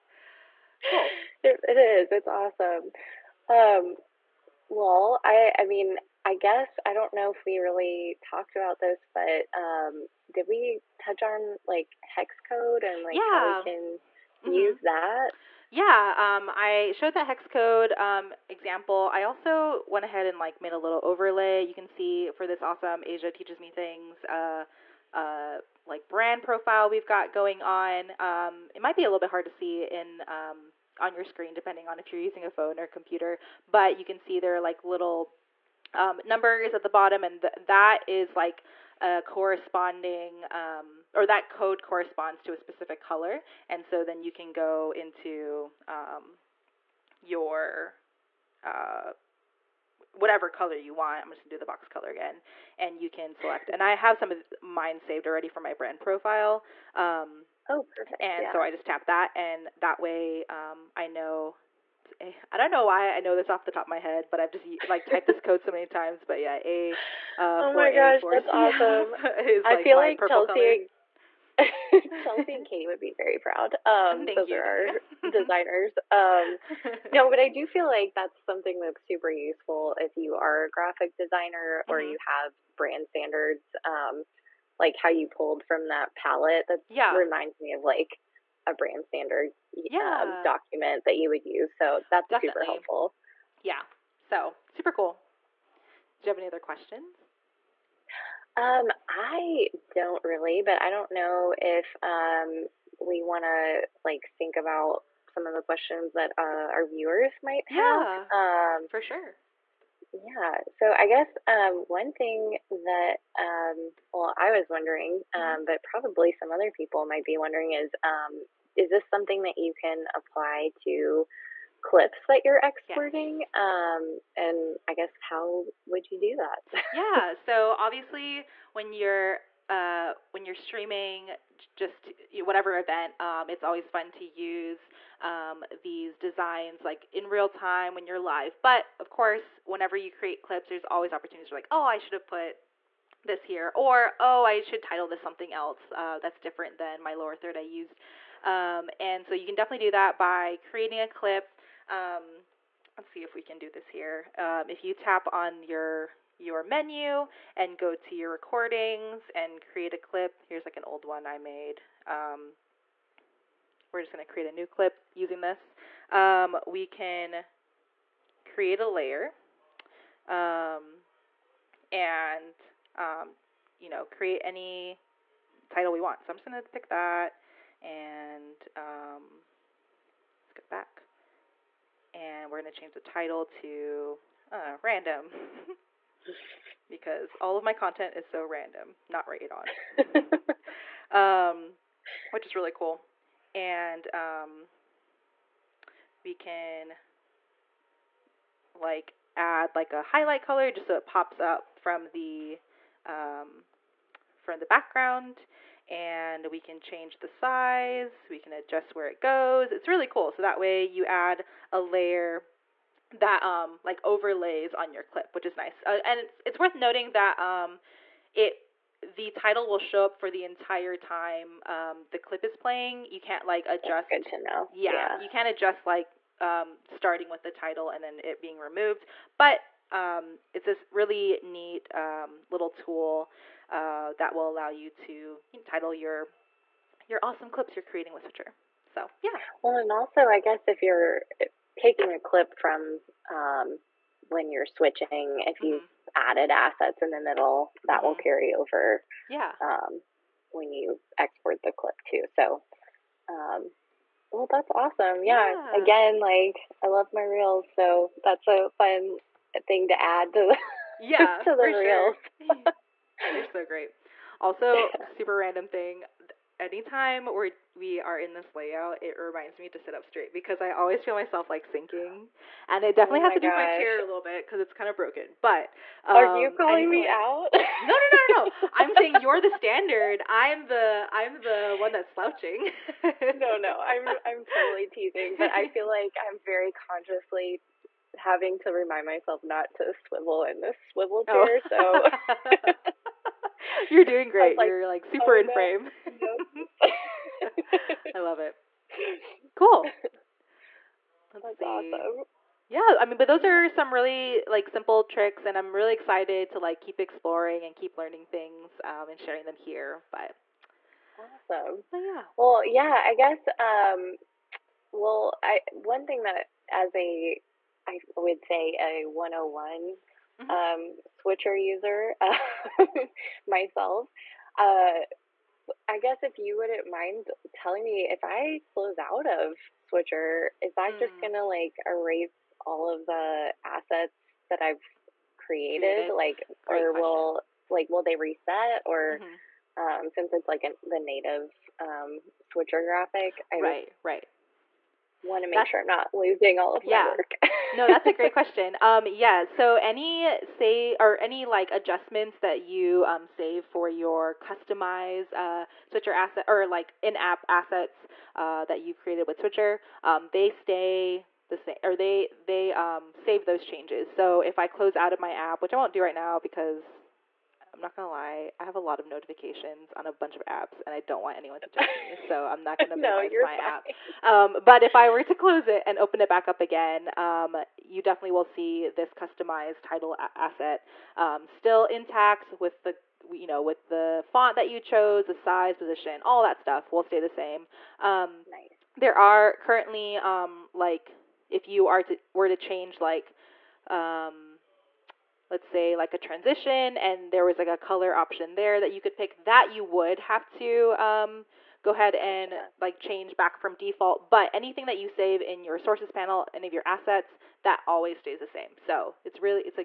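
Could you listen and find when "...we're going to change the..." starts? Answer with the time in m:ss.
3:02.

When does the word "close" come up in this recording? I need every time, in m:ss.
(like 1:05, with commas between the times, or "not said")
5:28, 6:04, 6:15.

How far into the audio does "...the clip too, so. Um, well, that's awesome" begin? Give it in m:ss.
4:11.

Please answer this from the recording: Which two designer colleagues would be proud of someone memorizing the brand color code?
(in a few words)
Chelsea and Katie.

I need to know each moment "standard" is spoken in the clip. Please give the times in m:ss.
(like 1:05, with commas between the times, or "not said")
1:23, 1:29, 4:39.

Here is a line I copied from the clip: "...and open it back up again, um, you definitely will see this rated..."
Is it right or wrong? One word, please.
wrong.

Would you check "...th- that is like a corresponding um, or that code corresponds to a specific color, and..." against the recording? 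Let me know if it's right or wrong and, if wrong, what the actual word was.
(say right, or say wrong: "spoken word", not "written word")
right.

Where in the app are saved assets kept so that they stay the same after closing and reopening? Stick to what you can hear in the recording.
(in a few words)
sources panel.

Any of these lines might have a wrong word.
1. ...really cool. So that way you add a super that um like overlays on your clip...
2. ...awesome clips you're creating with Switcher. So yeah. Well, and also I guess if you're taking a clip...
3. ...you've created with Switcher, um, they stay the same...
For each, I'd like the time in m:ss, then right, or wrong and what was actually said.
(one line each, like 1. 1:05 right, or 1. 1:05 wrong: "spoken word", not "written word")
1. 3:29 wrong: "layer", not "super"
2. 3:57 right
3. 5:58 right.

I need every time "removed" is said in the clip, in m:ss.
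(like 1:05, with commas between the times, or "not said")
3:48.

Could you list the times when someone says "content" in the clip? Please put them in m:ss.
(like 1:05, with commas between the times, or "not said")
3:07.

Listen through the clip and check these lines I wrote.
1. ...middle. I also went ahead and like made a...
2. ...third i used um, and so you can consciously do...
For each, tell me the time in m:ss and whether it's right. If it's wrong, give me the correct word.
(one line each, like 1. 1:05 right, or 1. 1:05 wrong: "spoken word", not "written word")
1. 0:18 wrong: "example", not "middle"
2. 2:27 wrong: "definitely", not "consciously".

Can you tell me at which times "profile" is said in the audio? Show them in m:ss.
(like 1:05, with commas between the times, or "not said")
0:26, 0:56.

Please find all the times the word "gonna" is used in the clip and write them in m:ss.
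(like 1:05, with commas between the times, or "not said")
0:51, 2:44, 2:56, 5:31, 6:07, 6:12.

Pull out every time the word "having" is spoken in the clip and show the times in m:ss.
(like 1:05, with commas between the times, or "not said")
4:48.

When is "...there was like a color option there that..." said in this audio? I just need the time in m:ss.
6:37.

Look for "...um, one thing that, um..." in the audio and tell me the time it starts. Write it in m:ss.
1:51.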